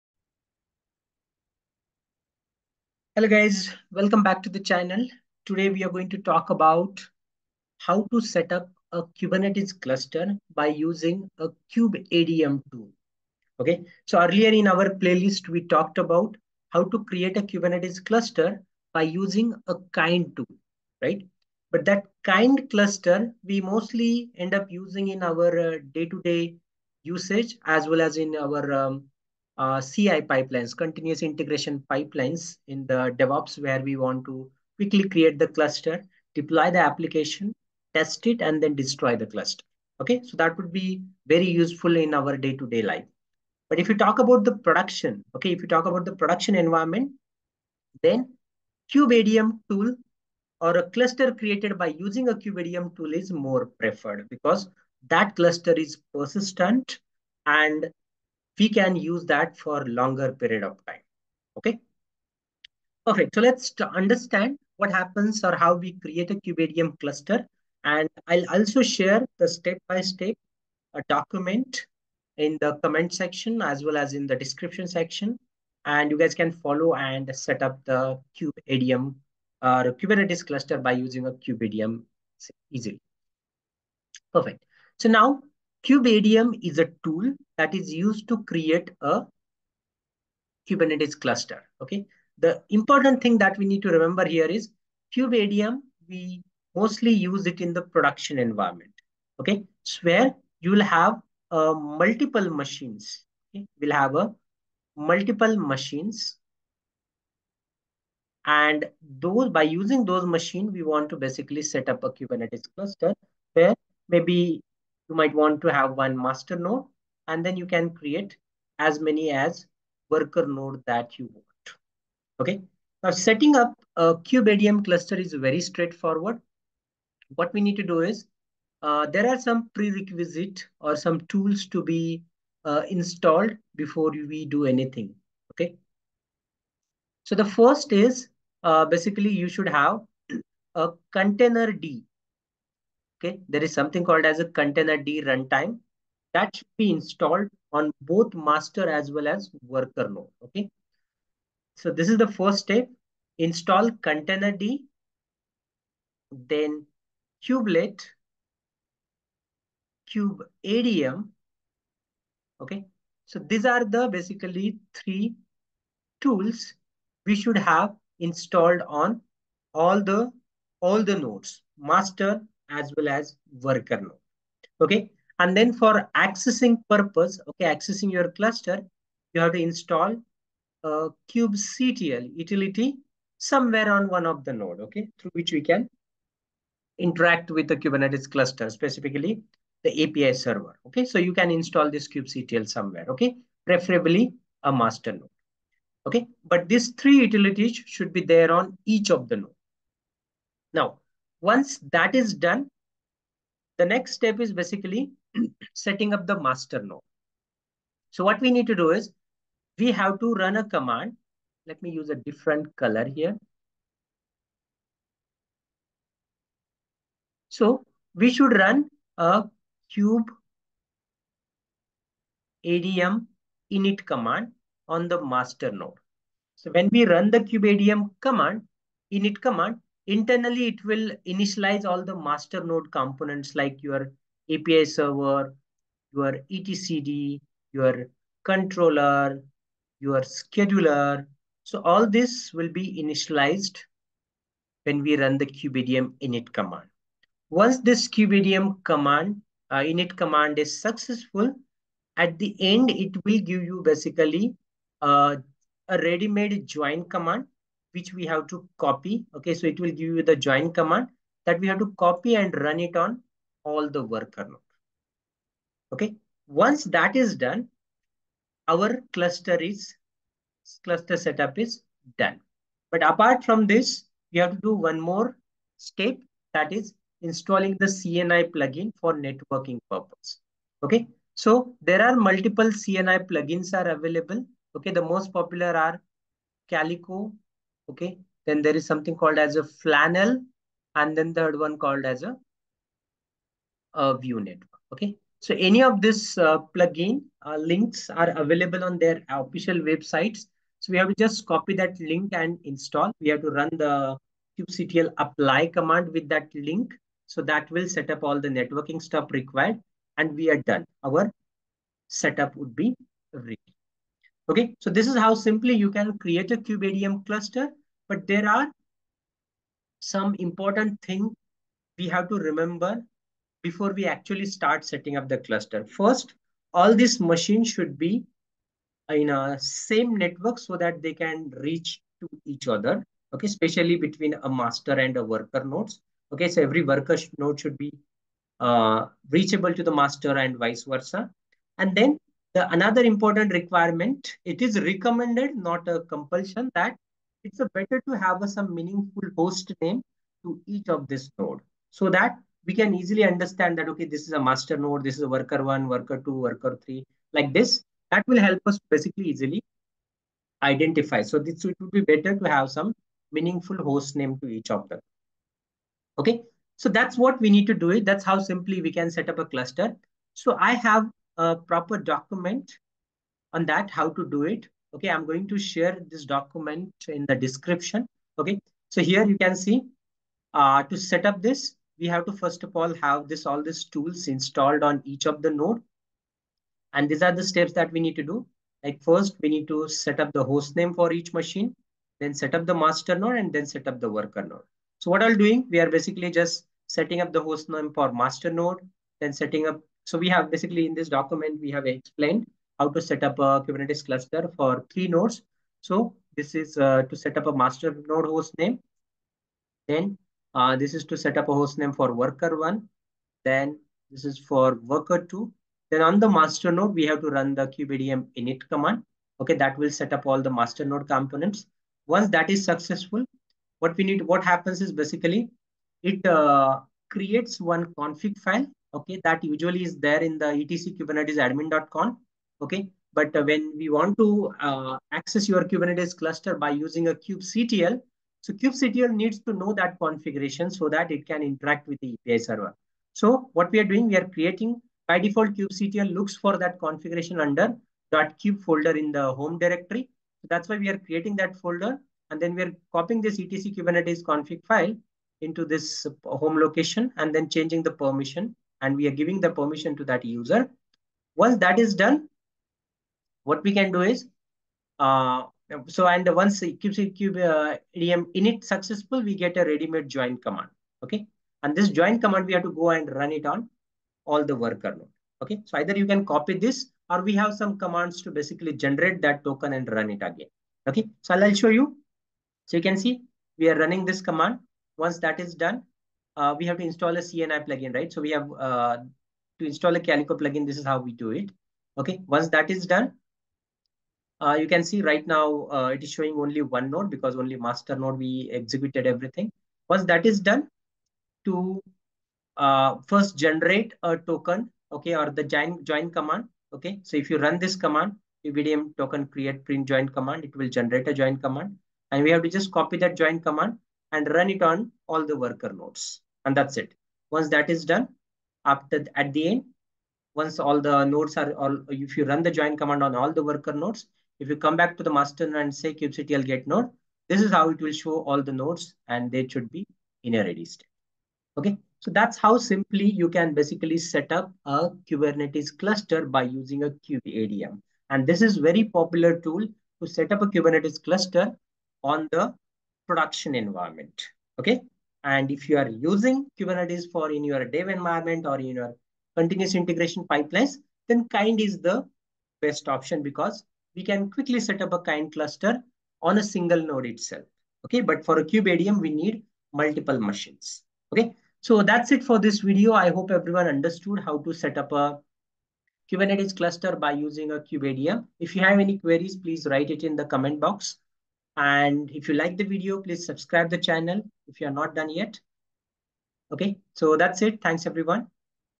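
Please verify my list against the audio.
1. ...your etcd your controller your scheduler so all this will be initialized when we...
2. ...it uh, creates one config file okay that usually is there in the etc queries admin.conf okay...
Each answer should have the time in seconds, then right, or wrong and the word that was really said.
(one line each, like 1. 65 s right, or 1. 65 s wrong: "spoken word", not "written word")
1. 236 s right
2. 426 s wrong: "kubernetes", not "queries".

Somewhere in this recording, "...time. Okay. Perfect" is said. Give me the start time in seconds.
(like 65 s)
60 s.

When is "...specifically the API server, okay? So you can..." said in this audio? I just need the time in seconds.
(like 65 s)
188 s.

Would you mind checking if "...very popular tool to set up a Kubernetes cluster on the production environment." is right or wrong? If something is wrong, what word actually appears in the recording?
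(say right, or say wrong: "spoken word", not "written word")
right.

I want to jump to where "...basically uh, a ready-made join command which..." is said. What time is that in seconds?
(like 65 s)
253 s.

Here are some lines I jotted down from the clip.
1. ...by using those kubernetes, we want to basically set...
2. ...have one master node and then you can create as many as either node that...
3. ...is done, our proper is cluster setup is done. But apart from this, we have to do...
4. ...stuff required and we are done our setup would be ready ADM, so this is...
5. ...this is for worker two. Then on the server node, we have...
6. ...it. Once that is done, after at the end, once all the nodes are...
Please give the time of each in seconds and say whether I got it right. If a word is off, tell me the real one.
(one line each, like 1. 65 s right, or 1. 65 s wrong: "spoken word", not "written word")
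1. 109 s wrong: "machines", not "kubernetes"
2. 115 s wrong: "worker", not "either"
3. 267 s wrong: "cluster", not "proper"
4. 309 s wrong: "Okay", not "ADM"
5. 414 s wrong: "master", not "server"
6. 516 s right.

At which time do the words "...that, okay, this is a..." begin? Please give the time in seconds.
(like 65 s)
353 s.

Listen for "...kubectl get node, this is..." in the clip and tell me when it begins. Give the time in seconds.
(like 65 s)
525 s.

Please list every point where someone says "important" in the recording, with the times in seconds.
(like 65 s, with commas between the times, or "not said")
92 s, 320 s, 343 s.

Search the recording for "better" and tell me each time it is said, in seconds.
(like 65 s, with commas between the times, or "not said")
347 s, 362 s.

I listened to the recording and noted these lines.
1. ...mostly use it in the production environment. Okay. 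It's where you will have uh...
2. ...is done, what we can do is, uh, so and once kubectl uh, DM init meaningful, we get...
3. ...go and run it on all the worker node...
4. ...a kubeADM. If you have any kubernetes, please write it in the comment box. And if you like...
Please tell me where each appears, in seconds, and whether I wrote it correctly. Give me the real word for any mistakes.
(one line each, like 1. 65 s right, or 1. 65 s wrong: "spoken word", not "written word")
1. 96 s right
2. 461 s wrong: "successful", not "meaningful"
3. 472 s right
4. 567 s wrong: "queries", not "kubernetes".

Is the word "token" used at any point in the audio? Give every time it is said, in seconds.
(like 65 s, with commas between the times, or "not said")
479 s, 504 s, 508 s.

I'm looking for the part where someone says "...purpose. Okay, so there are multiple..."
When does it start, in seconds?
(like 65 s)
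279 s.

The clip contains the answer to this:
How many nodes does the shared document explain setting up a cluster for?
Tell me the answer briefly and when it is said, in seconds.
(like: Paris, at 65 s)
3, at 404 s.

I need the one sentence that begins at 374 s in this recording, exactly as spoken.
Okay, I'm going to share this document in the description.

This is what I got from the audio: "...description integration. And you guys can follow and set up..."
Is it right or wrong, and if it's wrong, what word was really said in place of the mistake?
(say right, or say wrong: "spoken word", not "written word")
wrong: "section", not "integration".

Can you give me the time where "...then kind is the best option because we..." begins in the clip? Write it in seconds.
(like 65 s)
551 s.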